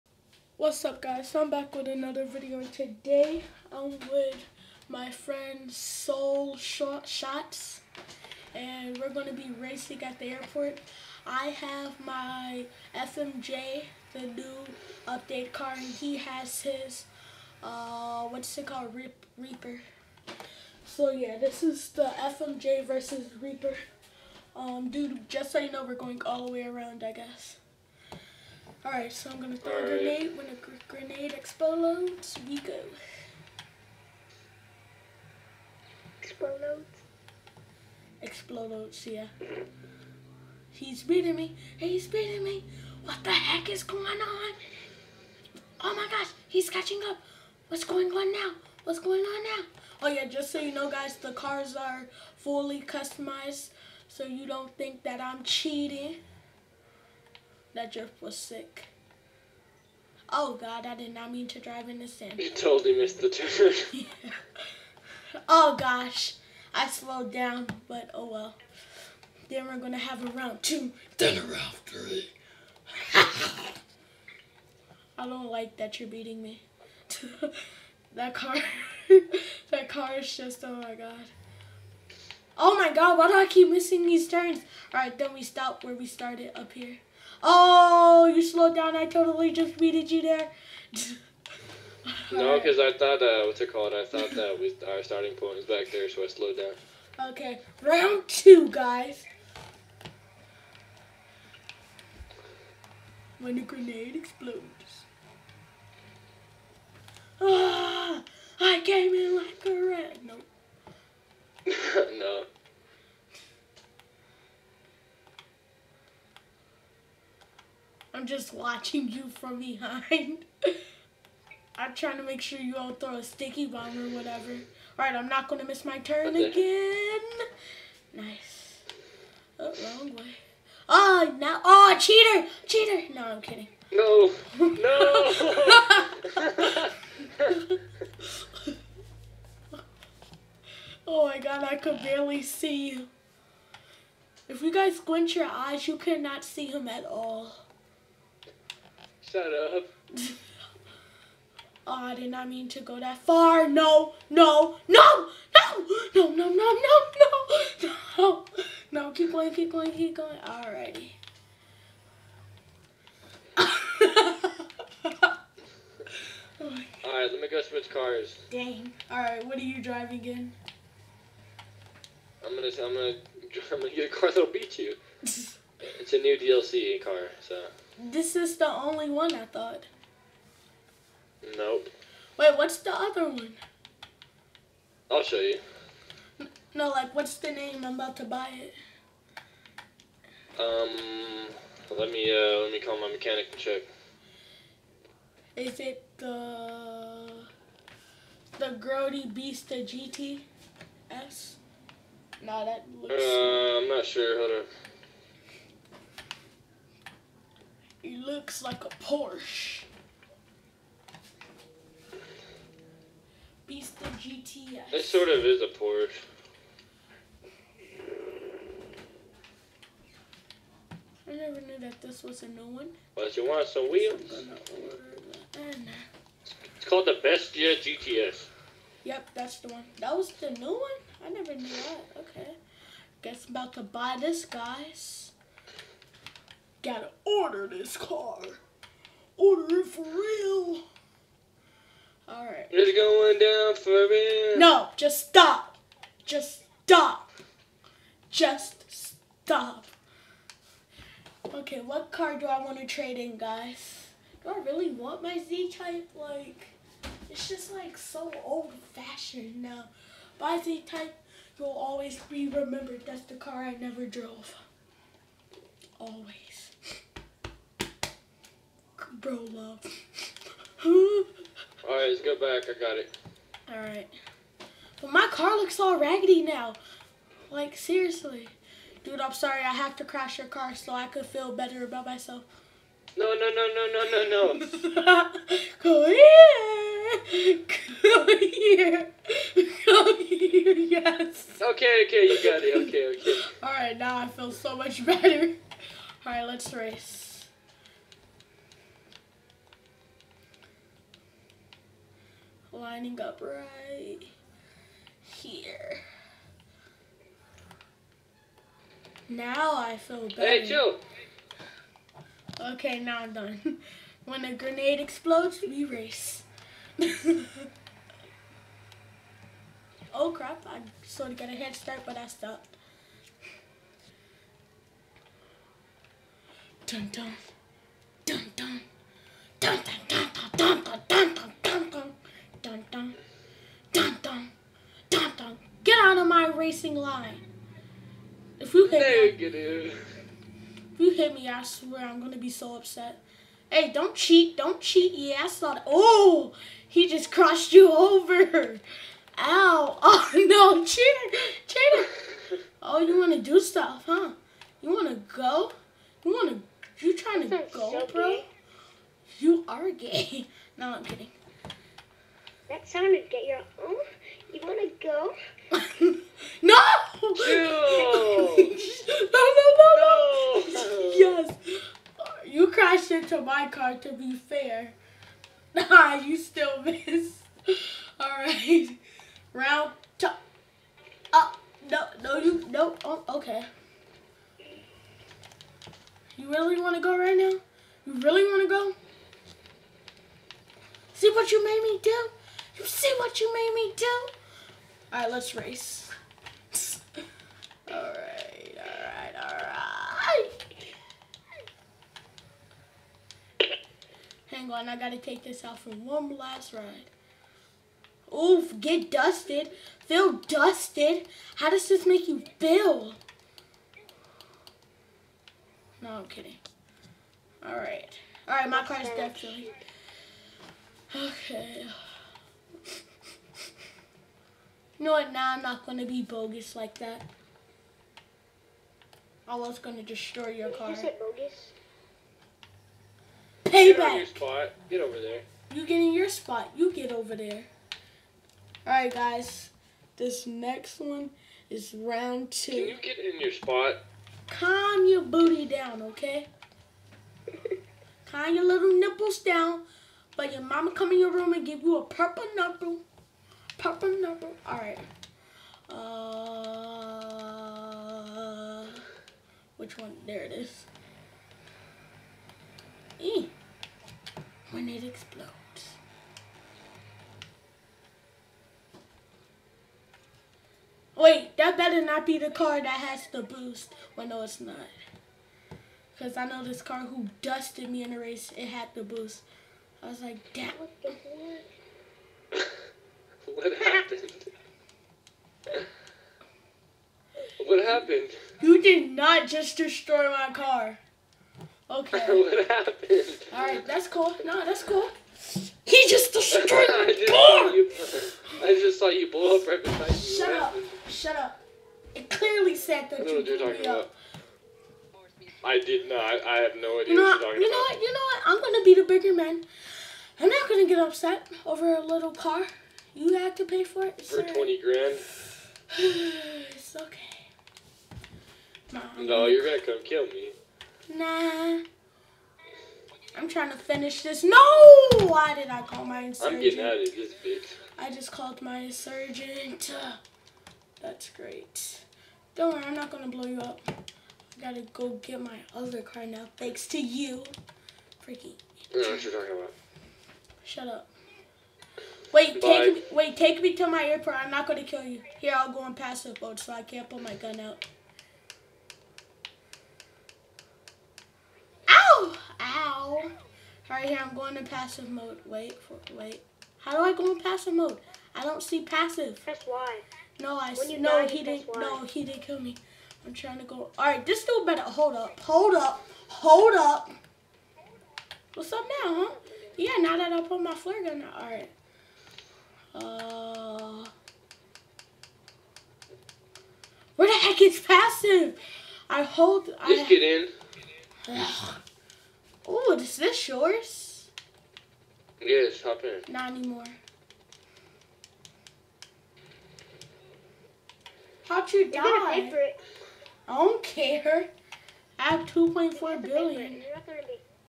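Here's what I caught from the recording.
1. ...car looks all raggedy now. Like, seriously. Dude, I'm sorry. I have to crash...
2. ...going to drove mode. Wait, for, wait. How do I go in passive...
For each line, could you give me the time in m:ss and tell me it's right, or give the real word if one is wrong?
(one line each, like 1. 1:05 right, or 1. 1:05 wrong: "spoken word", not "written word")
1. 4:35 right
2. 9:14 wrong: "passive", not "drove".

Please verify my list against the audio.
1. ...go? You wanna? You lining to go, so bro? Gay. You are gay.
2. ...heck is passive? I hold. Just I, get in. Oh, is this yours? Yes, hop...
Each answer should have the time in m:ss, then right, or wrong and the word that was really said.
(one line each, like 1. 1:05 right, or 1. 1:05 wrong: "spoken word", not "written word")
1. 5:55 wrong: "trying", not "lining"
2. 9:37 right.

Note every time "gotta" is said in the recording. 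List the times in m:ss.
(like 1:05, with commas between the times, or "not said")
3:56, 6:44, 8:54.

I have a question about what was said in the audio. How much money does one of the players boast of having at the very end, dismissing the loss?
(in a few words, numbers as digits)
2.4 billion.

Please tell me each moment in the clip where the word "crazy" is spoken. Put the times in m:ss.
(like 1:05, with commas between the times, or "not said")
not said.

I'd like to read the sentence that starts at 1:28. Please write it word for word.
I totally just beated you there.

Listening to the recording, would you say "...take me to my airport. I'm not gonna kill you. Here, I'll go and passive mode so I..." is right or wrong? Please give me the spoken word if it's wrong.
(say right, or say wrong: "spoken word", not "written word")
right.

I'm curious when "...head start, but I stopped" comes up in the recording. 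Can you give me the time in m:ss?
5:21.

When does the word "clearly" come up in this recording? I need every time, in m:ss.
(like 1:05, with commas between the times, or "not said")
8:22.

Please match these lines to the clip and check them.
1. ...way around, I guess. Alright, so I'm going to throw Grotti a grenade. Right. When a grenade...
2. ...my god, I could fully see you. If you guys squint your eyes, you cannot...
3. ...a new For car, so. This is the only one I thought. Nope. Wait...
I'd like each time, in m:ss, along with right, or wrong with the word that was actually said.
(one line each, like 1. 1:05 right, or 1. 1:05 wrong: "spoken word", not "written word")
1. 0:26 wrong: "All", not "Grotti"
2. 2:21 wrong: "barely", not "fully"
3. 2:56 wrong: "DLC", not "For".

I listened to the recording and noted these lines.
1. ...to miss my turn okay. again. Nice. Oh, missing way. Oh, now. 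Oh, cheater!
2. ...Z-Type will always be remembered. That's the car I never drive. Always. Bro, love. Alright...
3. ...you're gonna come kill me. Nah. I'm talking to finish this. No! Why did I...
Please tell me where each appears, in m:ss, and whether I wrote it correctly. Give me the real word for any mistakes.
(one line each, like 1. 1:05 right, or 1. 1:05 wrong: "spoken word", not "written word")
1. 2:05 wrong: "wrong", not "missing"
2. 4:20 wrong: "drove", not "drive"
3. 8:39 wrong: "trying", not "talking".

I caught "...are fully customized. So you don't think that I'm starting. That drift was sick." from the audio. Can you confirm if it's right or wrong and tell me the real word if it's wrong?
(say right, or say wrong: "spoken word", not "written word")
wrong: "cheating", not "starting".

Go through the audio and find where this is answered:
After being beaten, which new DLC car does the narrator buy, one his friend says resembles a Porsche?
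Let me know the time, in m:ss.
3:18.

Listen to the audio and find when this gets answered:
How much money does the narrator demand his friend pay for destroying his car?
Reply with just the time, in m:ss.
8:34.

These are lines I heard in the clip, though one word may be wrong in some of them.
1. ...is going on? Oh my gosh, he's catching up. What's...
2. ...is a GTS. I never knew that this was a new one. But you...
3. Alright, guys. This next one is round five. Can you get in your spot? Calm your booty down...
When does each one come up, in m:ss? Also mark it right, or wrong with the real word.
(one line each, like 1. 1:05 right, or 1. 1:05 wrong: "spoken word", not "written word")
1. 0:43 right
2. 3:35 wrong: "Porsche", not "GTS"
3. 7:18 wrong: "two", not "five".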